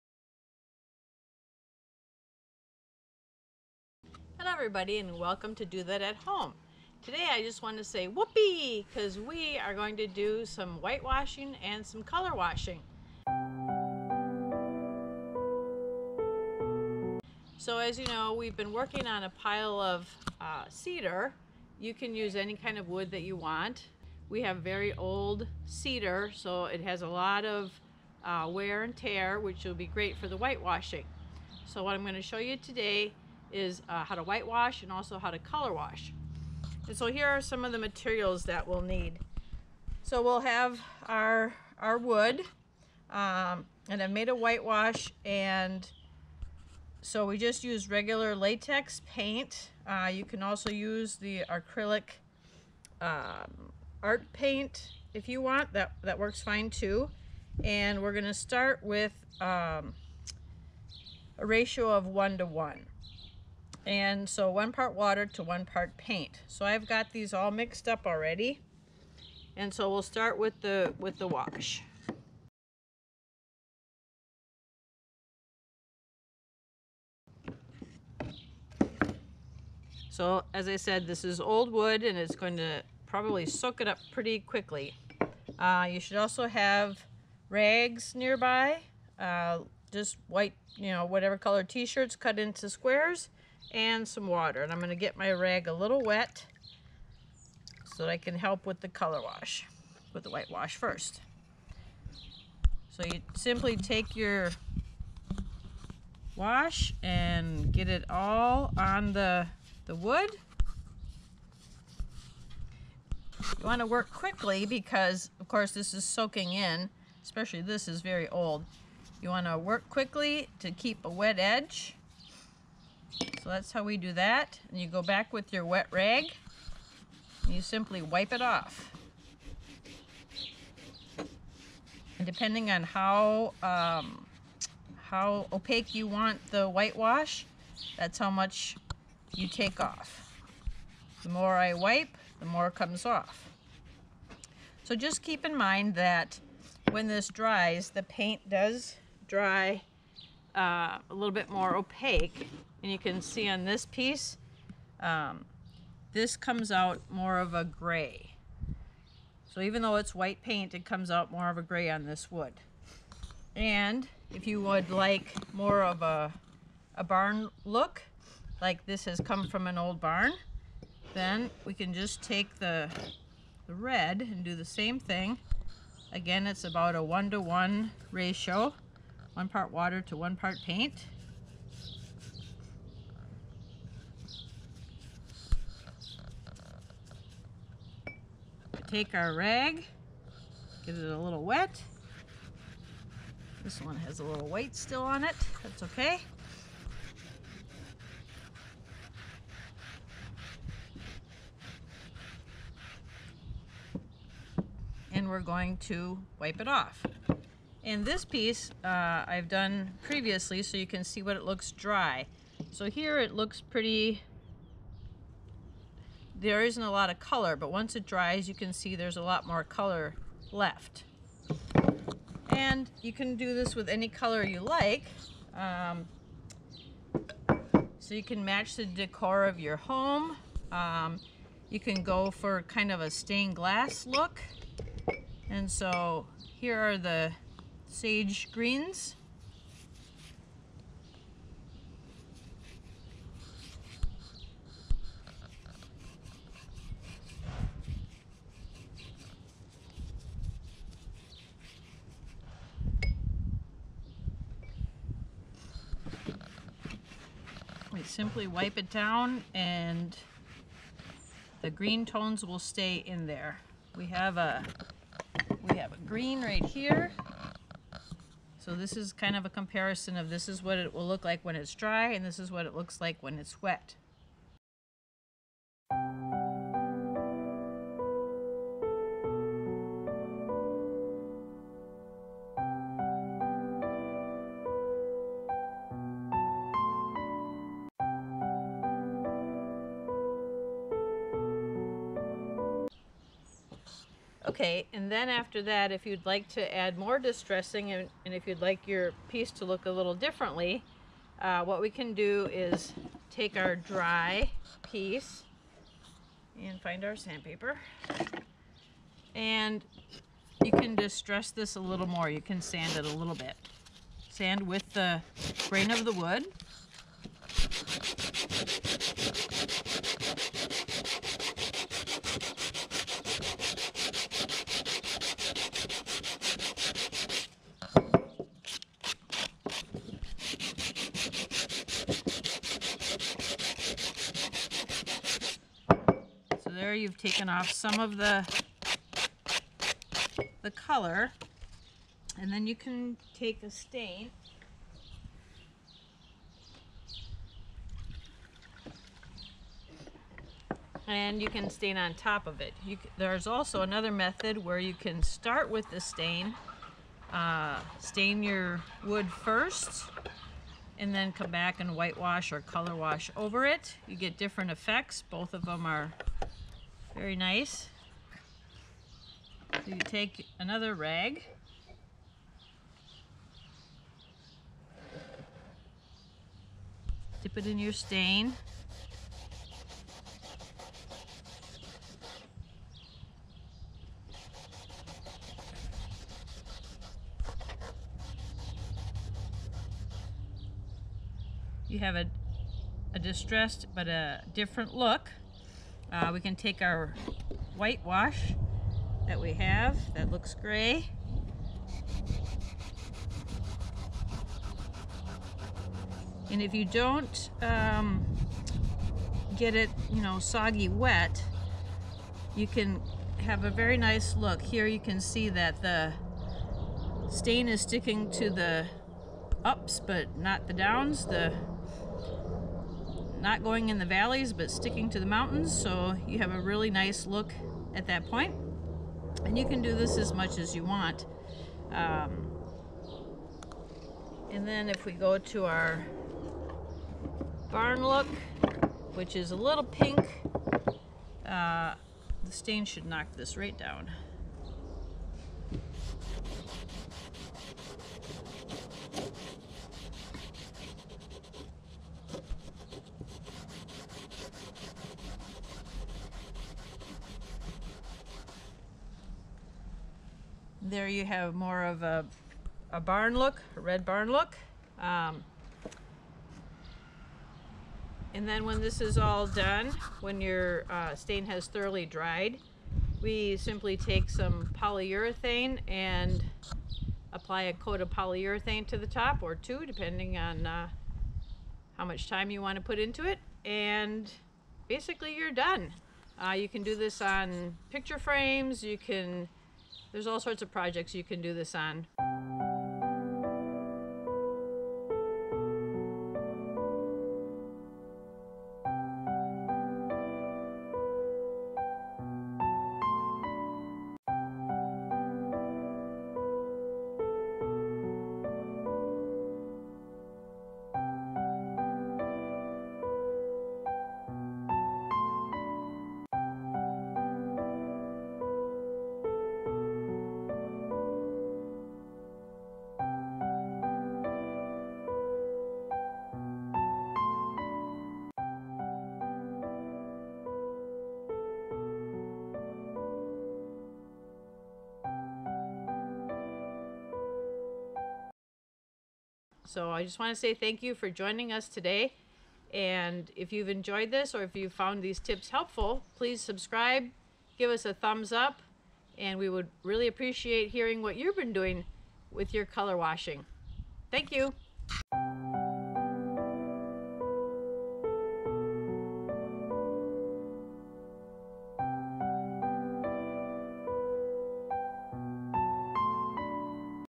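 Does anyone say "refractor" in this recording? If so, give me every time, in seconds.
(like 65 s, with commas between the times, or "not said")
not said.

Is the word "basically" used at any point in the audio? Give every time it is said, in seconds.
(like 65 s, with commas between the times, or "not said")
484 s.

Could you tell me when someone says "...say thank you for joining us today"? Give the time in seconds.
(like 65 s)
540 s.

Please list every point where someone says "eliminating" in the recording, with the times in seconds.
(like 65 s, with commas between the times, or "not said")
not said.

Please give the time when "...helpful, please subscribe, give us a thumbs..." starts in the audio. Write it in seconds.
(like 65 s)
545 s.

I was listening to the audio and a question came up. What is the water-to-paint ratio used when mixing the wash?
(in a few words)
1 to 1.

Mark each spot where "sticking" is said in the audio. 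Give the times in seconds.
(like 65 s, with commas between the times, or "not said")
417 s, 424 s.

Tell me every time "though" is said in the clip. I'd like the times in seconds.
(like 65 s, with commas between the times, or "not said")
159 s.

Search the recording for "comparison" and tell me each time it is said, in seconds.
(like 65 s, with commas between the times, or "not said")
269 s.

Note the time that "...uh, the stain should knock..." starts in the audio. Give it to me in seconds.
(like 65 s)
441 s.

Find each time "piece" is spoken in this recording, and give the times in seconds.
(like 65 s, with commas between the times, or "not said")
153 s, 208 s, 299 s, 304 s.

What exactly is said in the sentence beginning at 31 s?
So what I'm going to show you today is uh, how to whitewash and also how to color wash.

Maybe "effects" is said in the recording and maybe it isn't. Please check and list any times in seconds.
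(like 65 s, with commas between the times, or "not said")
364 s.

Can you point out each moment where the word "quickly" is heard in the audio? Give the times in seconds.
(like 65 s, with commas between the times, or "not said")
84 s, 114 s, 119 s.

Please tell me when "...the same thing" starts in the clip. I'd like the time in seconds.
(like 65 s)
174 s.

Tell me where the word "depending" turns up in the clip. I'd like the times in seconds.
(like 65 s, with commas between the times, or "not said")
132 s, 479 s.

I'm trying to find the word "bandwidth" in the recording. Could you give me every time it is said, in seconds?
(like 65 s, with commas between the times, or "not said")
not said.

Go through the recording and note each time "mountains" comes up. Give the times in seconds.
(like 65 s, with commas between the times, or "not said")
425 s.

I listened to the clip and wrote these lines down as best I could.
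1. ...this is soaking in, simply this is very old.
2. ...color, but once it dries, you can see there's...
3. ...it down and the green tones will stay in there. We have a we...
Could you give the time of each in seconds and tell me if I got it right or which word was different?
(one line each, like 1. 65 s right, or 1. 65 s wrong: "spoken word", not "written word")
1. 115 s wrong: "especially", not "simply"
2. 217 s right
3. 258 s right.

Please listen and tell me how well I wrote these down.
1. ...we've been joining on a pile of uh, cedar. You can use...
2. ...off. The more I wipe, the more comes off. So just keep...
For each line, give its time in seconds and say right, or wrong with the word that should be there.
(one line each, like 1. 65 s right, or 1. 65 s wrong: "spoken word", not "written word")
1. 18 s wrong: "working", not "joining"
2. 139 s right.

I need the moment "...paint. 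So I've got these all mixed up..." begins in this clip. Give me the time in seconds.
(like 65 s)
65 s.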